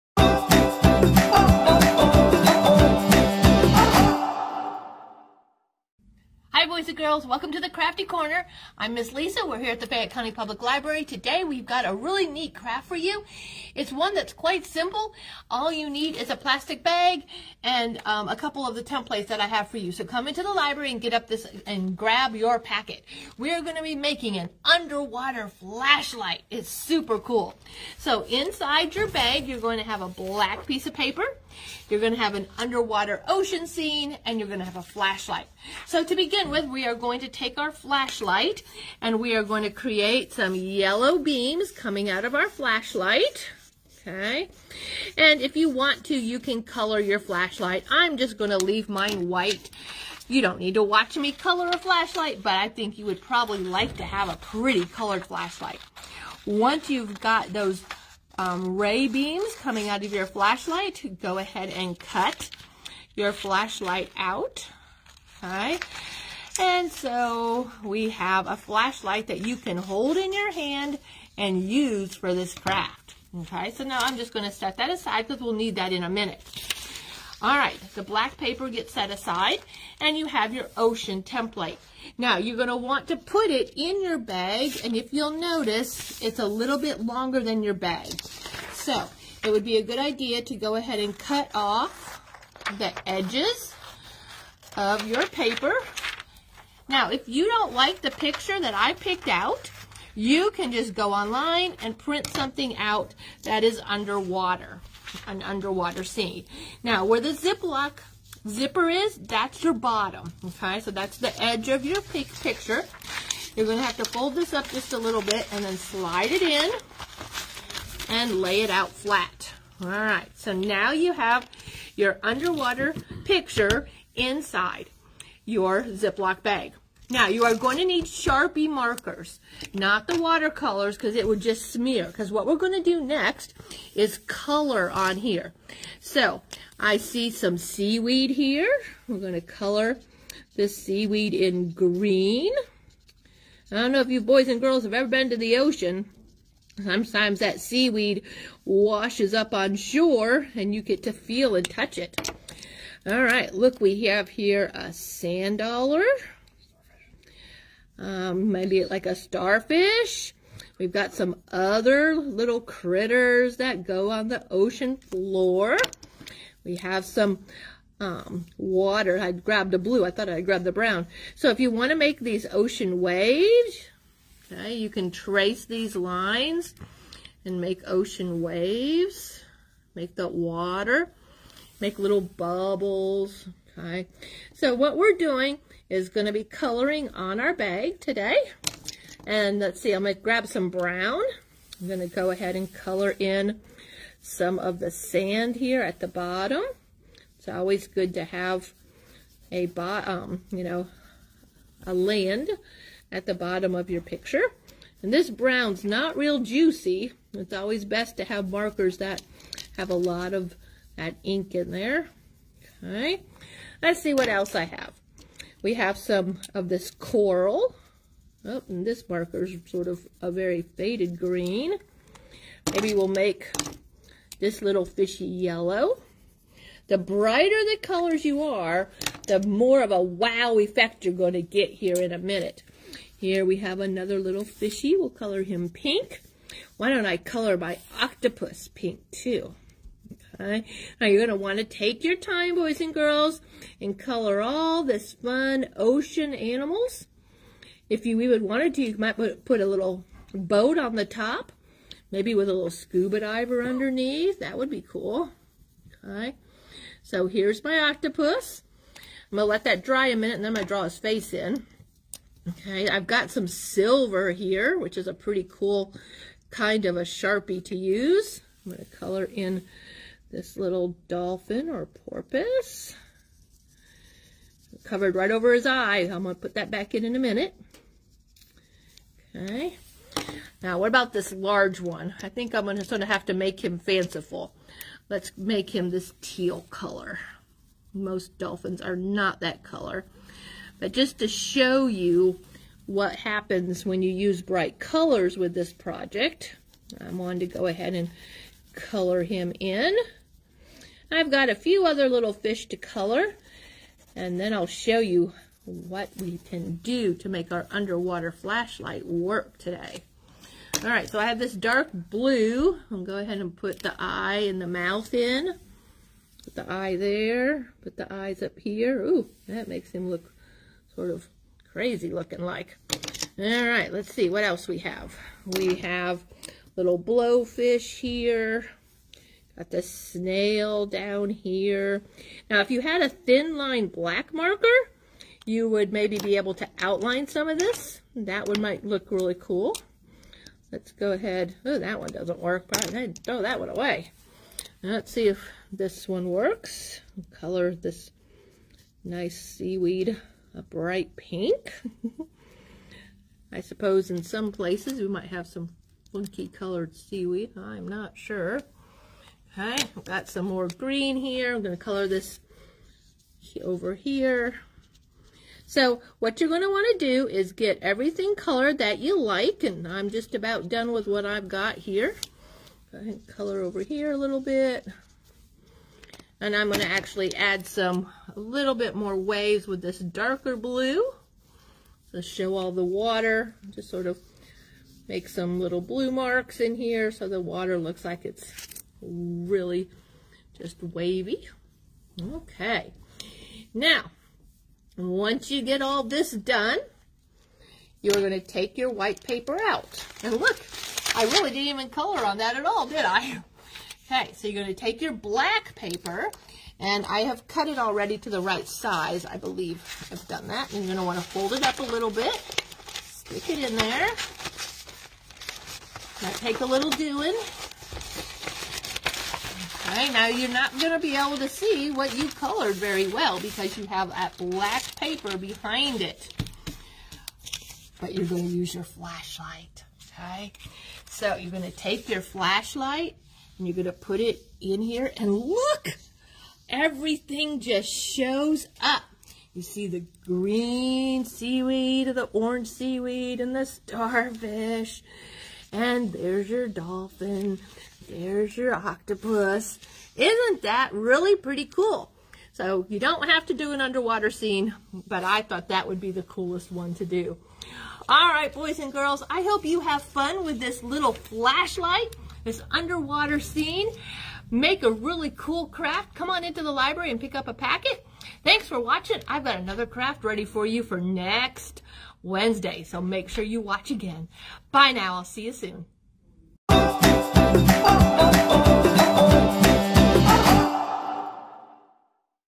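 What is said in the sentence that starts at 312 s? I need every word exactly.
I'll go ahead and put the eye and the mouth in.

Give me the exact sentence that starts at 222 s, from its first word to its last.
Maybe we'll make this little fishy yellow.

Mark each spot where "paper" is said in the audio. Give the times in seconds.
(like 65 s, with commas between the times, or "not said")
30 s, 78 s, 95 s, 399 s, 405 s, 424 s.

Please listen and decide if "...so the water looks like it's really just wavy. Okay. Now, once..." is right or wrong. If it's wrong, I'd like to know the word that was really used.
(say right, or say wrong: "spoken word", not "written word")
right.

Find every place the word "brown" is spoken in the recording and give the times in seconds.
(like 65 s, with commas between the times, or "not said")
170 s, 190 s, 205 s.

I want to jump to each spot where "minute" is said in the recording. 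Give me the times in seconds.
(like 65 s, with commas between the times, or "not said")
76 s, 232 s, 260 s, 277 s.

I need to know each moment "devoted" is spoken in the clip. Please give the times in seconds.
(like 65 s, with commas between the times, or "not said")
not said.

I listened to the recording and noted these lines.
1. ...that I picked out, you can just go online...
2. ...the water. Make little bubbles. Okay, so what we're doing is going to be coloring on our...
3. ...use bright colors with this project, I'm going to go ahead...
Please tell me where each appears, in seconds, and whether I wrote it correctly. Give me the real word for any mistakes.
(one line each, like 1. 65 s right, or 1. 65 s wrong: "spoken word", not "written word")
1. 98 s right
2. 180 s right
3. 294 s right.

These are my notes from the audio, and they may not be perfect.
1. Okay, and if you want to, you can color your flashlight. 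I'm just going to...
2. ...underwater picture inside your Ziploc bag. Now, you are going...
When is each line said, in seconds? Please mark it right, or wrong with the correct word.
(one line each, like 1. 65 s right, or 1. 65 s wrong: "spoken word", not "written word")
1. 44 s right
2. 122 s right.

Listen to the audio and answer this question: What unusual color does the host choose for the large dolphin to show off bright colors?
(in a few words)
teal.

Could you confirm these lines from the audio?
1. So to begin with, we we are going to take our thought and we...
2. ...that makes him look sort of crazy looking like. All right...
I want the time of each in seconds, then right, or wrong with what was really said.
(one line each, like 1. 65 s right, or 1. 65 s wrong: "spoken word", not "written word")
1. 35 s wrong: "flashlight", not "thought"
2. 319 s right.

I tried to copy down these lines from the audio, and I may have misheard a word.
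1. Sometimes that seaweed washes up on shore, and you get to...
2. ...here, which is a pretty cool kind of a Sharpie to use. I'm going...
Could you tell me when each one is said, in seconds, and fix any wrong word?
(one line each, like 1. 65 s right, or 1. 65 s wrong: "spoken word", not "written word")
1. 146 s right
2. 264 s right.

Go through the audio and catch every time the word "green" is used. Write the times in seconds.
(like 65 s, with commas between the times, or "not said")
141 s, 221 s, 360 s, 440 s.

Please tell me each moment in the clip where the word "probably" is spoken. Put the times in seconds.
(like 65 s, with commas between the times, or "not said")
53 s, 342 s.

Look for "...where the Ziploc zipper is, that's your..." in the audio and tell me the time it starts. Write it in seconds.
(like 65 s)
107 s.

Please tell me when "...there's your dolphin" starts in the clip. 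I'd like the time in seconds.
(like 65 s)
446 s.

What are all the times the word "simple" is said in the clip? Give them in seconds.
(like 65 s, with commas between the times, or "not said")
14 s.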